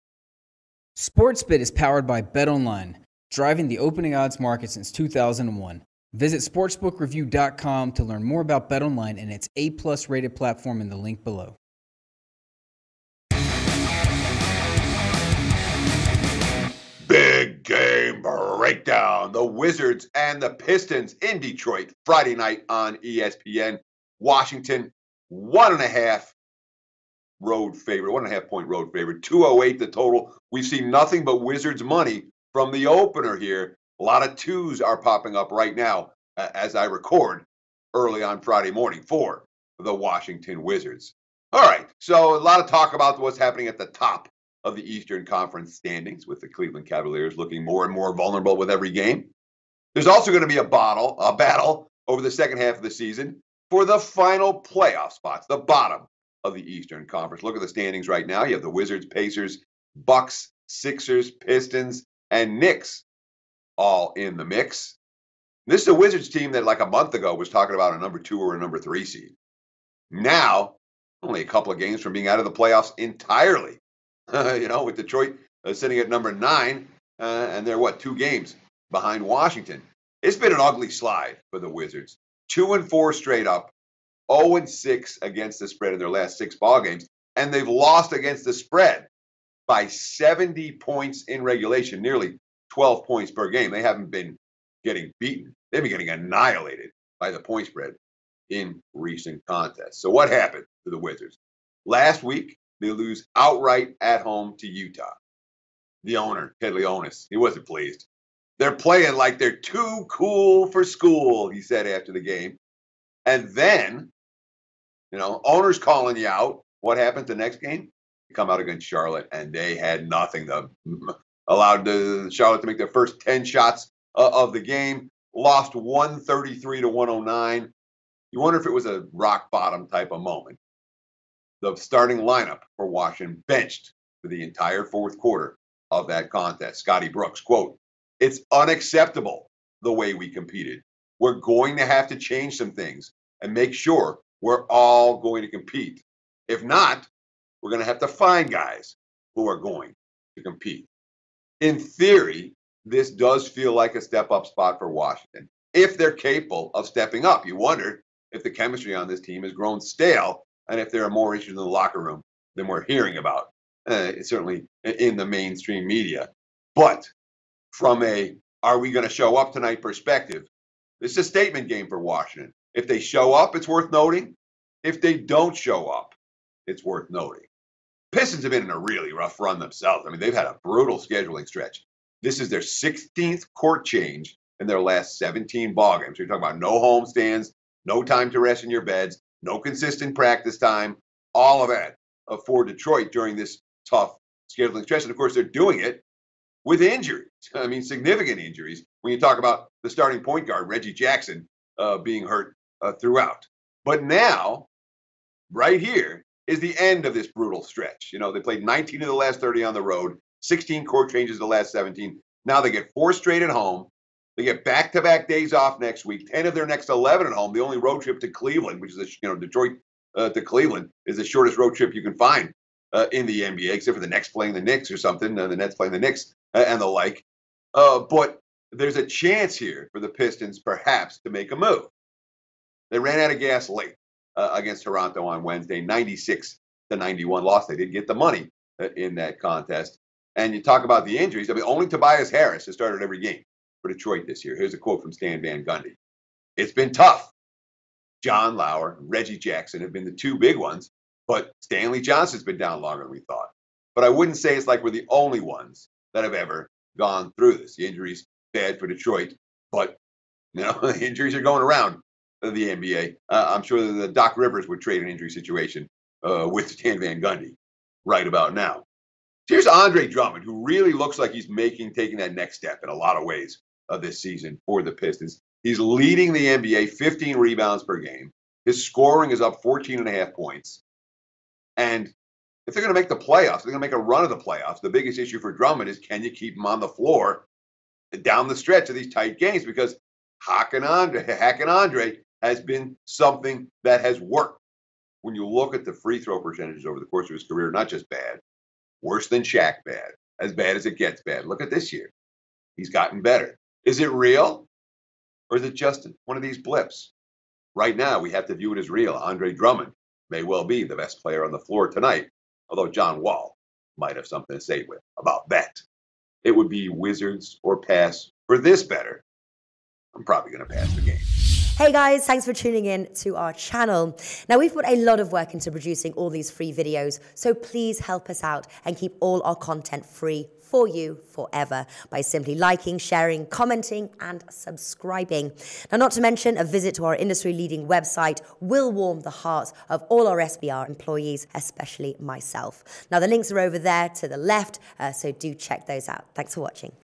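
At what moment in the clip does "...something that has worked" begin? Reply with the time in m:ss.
4:53.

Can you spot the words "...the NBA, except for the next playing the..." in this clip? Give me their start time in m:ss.
3:43.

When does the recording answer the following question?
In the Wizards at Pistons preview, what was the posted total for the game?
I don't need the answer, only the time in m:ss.
0:29.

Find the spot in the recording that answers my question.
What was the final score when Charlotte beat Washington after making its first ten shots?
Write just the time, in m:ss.
2:05.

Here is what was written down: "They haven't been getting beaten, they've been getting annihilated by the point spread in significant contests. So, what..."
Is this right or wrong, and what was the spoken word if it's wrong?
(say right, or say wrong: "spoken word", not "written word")
wrong: "recent", not "significant".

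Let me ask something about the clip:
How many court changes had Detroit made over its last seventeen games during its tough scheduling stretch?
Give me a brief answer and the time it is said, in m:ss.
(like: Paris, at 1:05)
16, at 3:02.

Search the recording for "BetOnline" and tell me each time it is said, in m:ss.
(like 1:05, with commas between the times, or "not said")
0:02, 0:08.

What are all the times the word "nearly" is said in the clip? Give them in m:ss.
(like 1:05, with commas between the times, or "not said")
1:32.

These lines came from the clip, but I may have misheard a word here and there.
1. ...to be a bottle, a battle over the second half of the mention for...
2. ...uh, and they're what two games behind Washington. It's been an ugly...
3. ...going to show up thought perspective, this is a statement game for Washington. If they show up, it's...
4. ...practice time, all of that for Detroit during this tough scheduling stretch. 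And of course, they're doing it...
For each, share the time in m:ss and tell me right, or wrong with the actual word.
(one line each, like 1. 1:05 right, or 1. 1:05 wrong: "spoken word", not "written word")
1. 0:50 wrong: "season", not "mention"
2. 1:17 right
3. 2:48 wrong: "tonight", not "thought"
4. 3:10 right.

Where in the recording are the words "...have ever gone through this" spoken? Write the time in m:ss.
4:16.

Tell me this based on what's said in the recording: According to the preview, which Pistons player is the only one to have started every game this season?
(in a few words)
Tobias Harris.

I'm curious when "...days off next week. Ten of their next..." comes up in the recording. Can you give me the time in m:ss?
3:35.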